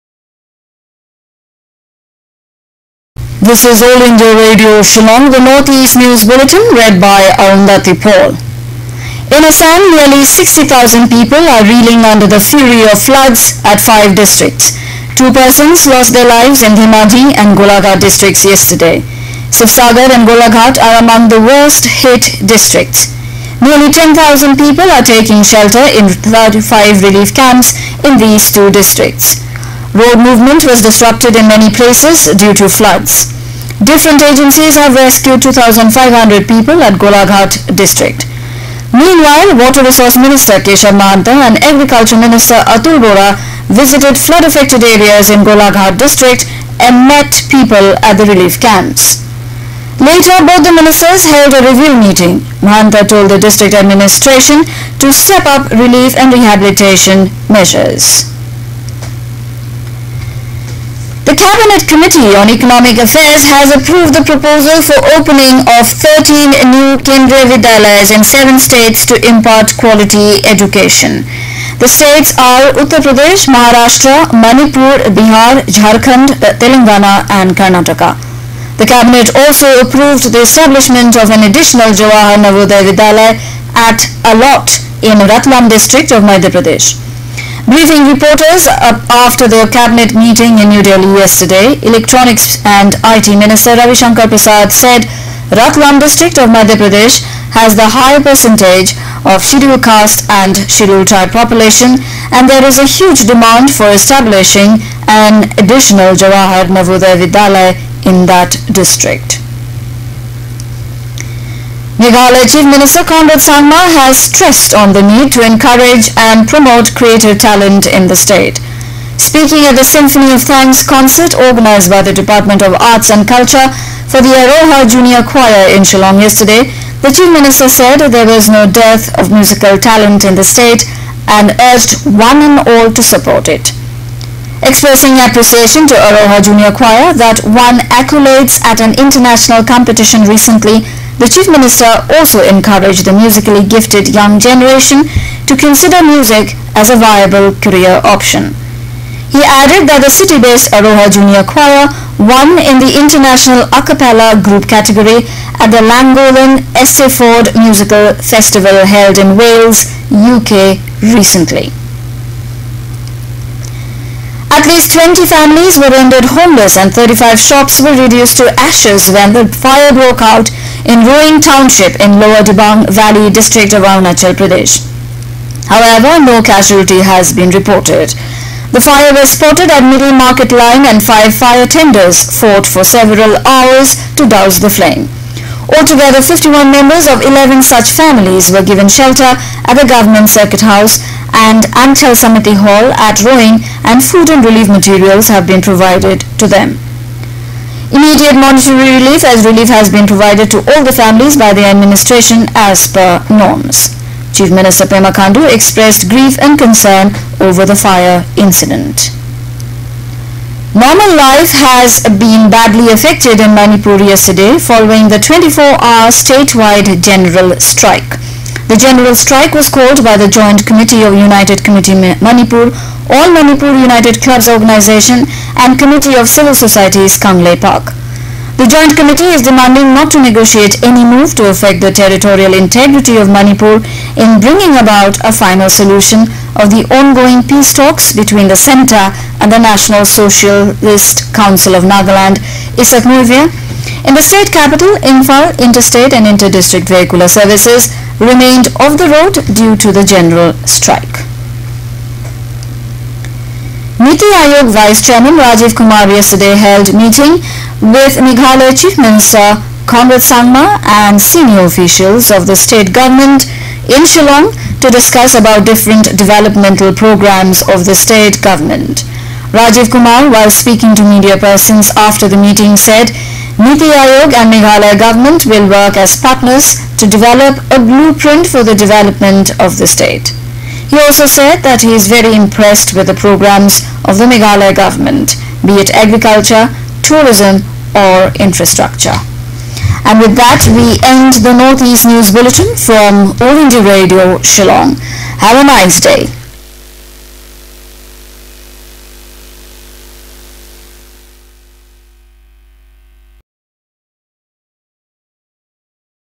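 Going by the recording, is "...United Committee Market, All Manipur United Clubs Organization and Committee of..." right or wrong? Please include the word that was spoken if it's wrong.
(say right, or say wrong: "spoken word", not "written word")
wrong: "Manipur", not "Market".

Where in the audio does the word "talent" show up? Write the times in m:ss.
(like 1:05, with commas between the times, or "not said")
1:57, 2:09.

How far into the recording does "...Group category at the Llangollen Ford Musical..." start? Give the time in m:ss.
2:34.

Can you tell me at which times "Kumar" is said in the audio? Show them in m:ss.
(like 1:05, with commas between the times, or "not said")
4:15, 4:29.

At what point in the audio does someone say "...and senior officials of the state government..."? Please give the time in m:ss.
4:20.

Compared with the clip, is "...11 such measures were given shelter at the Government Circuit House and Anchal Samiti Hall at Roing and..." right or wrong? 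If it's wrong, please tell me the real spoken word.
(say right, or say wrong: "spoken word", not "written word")
wrong: "families", not "measures".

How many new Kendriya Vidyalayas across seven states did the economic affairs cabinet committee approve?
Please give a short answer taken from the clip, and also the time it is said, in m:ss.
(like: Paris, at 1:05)
13, at 1:05.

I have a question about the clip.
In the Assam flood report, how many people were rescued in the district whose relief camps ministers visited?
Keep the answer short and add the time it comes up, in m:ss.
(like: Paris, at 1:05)
2,500, at 0:35.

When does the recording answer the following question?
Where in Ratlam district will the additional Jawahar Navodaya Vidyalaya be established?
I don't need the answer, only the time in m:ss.
1:24.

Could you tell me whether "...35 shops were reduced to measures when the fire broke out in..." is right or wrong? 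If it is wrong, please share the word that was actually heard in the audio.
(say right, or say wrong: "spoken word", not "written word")
wrong: "ashes", not "measures".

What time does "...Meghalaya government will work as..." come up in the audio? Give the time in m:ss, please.
4:34.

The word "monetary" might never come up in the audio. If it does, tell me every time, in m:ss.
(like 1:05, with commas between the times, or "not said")
3:18.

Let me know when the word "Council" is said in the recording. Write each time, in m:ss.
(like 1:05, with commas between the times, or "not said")
4:01.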